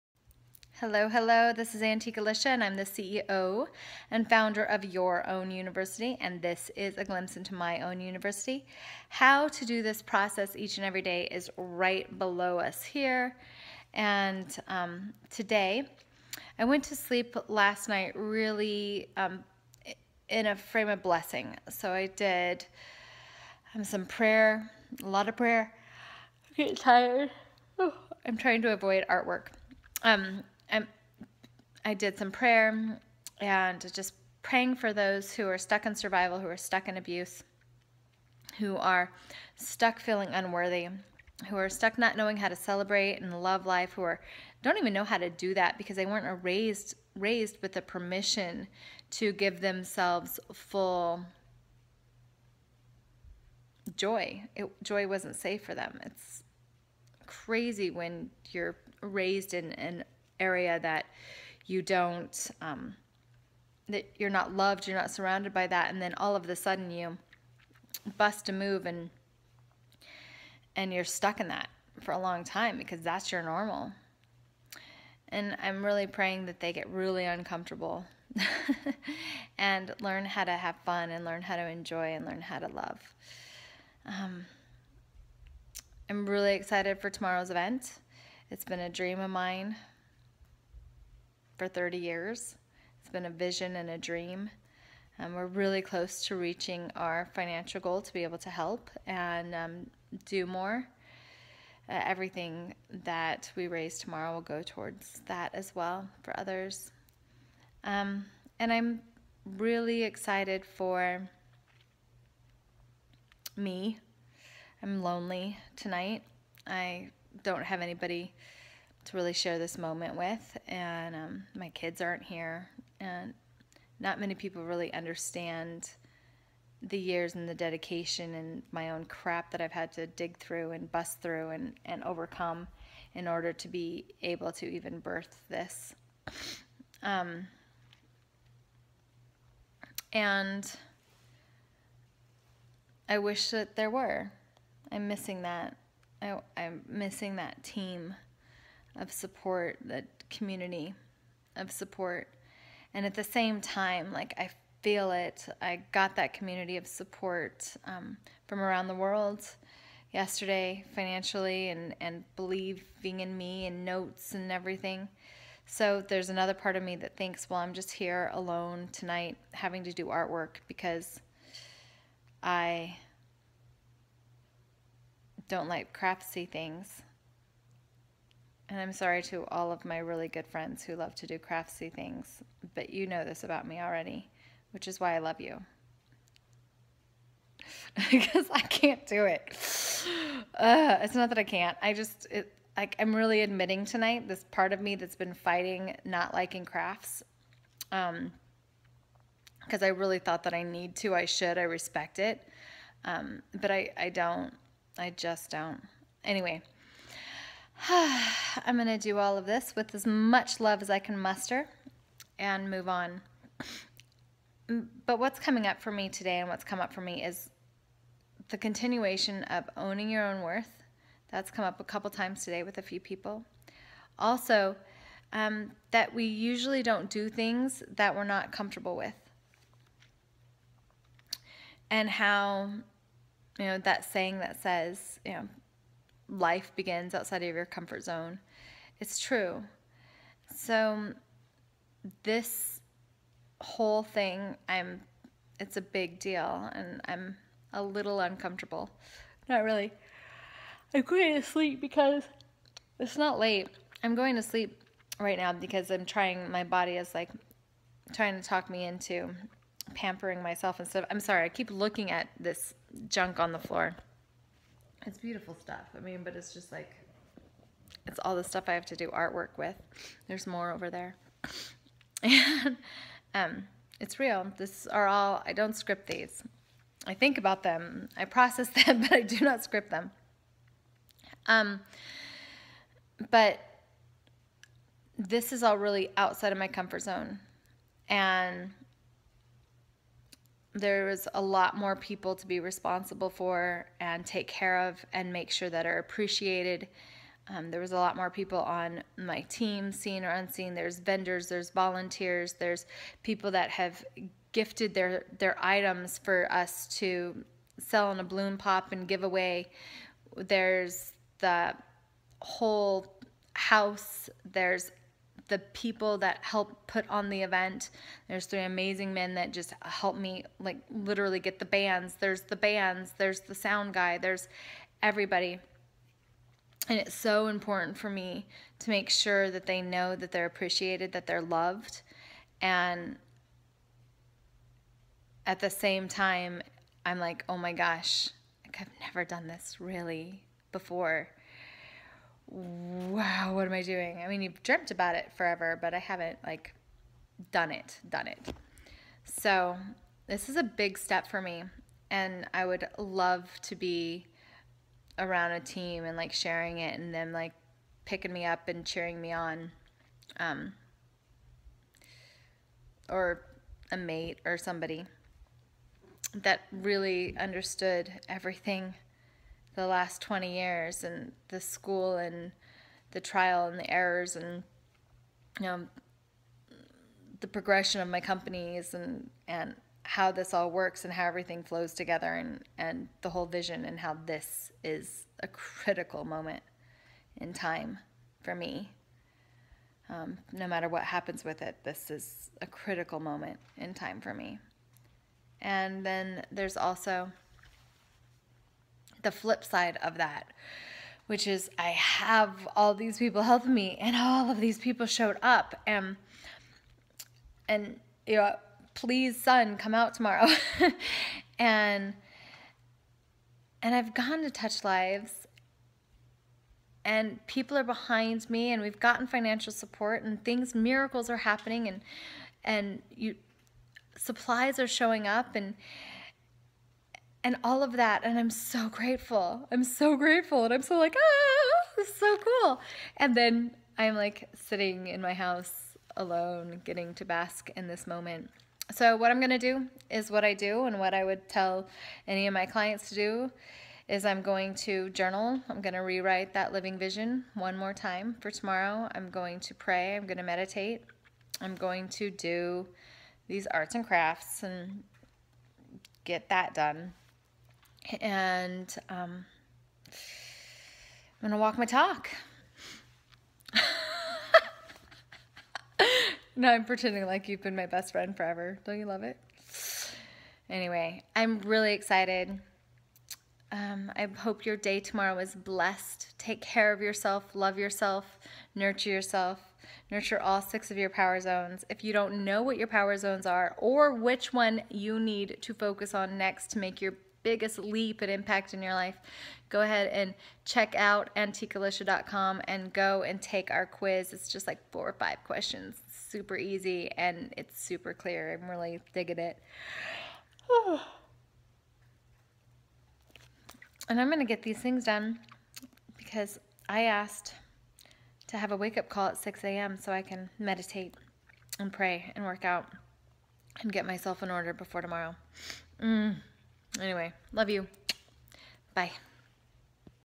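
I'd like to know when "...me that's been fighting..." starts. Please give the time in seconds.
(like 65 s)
194 s.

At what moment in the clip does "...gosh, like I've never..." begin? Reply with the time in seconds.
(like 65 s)
337 s.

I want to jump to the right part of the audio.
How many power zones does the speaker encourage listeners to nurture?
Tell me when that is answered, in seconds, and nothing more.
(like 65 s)
480 s.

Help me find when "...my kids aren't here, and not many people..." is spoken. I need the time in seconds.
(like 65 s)
121 s.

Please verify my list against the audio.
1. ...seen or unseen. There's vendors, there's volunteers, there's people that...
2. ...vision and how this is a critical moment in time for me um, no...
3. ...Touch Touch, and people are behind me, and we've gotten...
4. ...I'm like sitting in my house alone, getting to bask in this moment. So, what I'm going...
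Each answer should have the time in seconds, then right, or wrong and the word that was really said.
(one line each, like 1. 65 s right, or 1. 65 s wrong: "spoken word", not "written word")
1. 299 s right
2. 383 s right
3. 414 s wrong: "Lives", not "Touch"
4. 433 s right.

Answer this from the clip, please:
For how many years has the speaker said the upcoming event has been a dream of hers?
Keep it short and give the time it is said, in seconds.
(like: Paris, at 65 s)
30, at 91 s.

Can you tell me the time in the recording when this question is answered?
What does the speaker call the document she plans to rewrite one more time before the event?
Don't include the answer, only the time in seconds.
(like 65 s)
446 s.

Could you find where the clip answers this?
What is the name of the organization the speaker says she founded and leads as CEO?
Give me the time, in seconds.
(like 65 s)
4 s.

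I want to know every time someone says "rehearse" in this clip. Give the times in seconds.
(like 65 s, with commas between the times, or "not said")
not said.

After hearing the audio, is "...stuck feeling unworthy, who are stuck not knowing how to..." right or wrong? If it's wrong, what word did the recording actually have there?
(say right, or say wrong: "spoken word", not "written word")
right.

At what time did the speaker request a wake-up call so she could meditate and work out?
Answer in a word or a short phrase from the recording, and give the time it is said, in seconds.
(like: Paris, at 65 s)
6 a.m., at 509 s.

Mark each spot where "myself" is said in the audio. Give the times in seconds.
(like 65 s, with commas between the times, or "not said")
260 s, 514 s.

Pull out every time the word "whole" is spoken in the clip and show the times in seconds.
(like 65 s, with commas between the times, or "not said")
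243 s, 312 s, 383 s.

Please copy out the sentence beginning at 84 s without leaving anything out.
Um, I'm really excited for tomorrow's event.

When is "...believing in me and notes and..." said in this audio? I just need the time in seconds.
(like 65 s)
162 s.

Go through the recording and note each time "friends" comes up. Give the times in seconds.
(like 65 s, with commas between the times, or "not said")
180 s, 468 s.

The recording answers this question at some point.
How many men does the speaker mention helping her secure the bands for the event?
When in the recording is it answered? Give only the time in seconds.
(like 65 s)
318 s.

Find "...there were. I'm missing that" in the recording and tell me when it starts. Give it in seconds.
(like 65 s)
143 s.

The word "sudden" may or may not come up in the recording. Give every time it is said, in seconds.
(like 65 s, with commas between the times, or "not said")
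66 s.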